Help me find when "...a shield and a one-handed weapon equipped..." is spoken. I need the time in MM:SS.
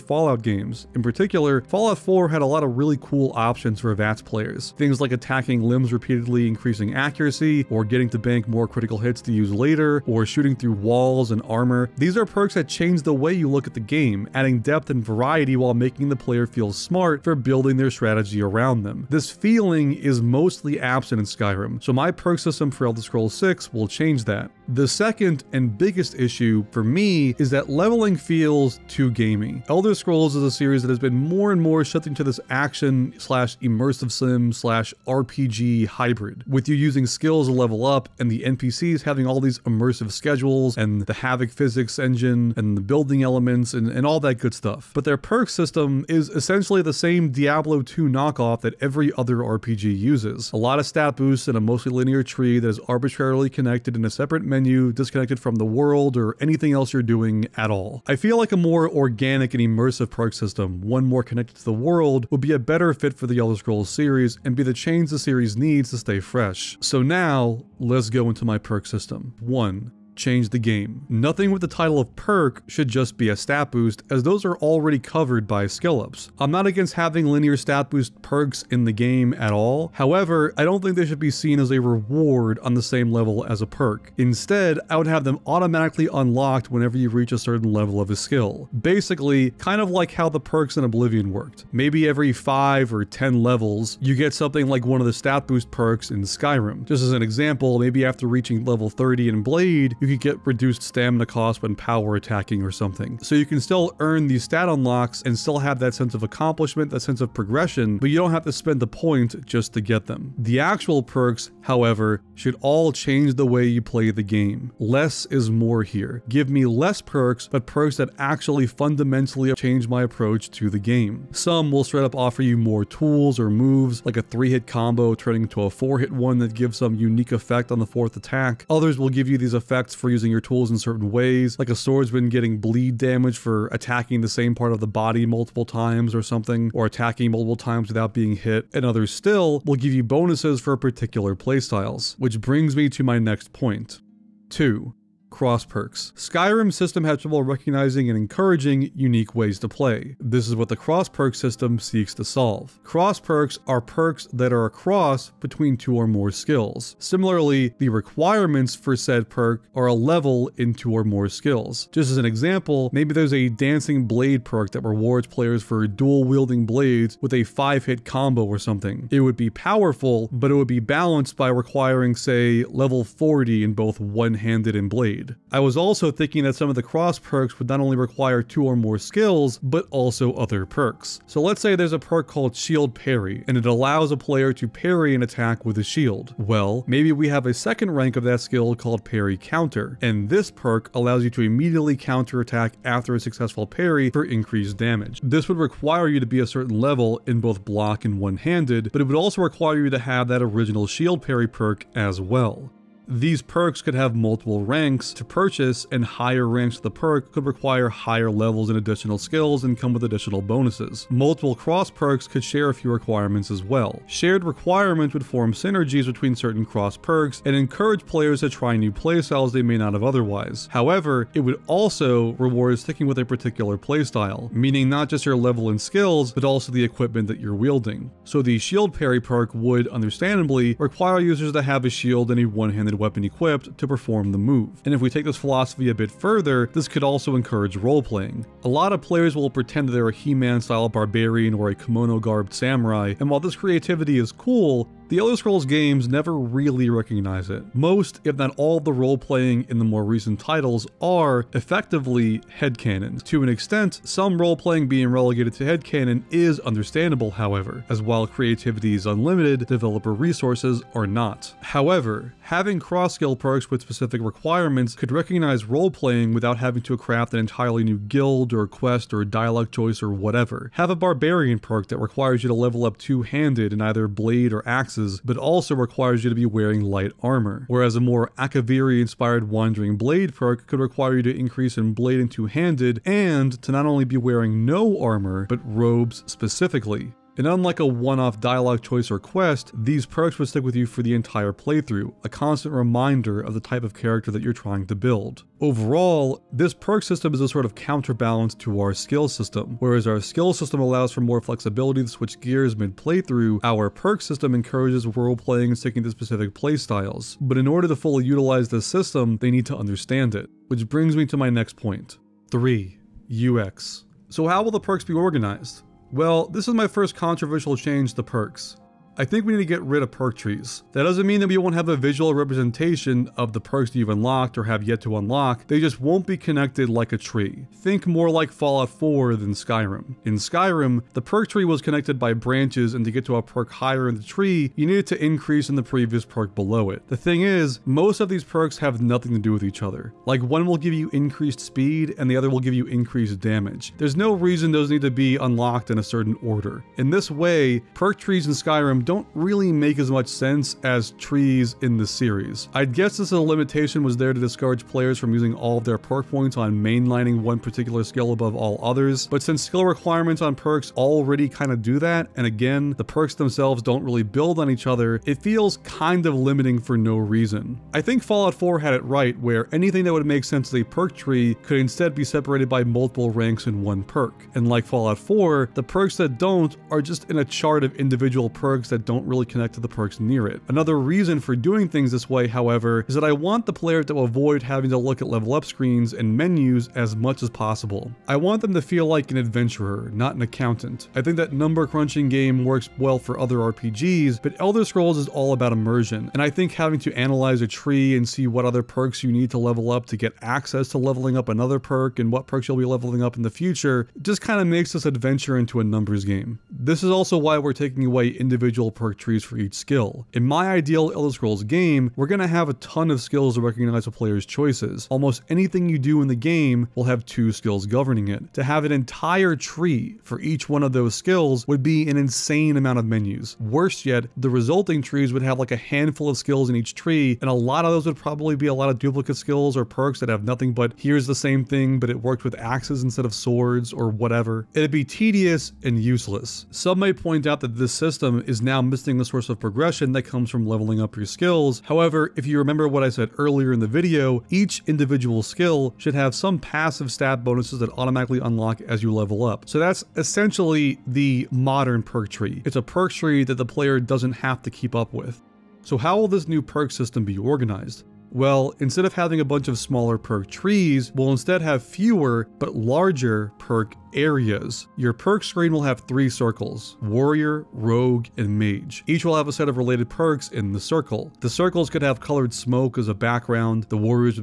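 03:51.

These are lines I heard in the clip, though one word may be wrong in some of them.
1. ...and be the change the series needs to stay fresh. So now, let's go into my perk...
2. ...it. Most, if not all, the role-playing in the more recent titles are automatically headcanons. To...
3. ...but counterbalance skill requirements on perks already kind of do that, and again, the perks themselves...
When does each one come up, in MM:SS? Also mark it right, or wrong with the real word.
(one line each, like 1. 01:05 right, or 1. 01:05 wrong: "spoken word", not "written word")
1. 01:04 right
2. 04:07 wrong: "effectively", not "automatically"
3. 05:59 wrong: "since", not "counterbalance".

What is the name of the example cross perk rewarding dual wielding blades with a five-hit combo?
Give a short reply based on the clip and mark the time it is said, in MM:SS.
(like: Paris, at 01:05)
Dancing Blade, at 02:43.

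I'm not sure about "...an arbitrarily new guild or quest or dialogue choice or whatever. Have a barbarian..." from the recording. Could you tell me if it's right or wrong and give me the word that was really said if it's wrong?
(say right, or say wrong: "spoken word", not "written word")
wrong: "entirely", not "arbitrarily".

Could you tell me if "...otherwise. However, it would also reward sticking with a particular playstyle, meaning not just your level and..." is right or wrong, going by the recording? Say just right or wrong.
right.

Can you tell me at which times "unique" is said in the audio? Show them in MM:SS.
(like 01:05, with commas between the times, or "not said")
02:06, 02:28.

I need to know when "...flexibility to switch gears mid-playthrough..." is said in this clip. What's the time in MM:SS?
05:01.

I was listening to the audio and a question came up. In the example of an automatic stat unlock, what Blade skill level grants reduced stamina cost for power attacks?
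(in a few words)
30.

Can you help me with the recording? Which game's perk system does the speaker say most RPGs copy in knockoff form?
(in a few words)
Diablo 2.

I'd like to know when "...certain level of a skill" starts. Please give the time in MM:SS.
01:27.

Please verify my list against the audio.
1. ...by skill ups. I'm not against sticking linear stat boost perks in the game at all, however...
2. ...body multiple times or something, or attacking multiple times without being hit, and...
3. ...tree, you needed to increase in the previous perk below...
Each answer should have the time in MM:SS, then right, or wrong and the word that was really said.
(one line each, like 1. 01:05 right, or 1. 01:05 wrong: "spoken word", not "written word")
1. 01:15 wrong: "having", not "sticking"
2. 02:14 right
3. 05:34 right.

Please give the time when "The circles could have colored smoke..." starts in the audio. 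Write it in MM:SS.
07:51.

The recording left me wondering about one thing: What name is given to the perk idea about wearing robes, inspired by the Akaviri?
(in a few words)
Wandering Blade.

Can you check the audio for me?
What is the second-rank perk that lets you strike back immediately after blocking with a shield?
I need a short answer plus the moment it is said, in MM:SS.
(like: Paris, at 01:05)
Parry Counter, at 03:09.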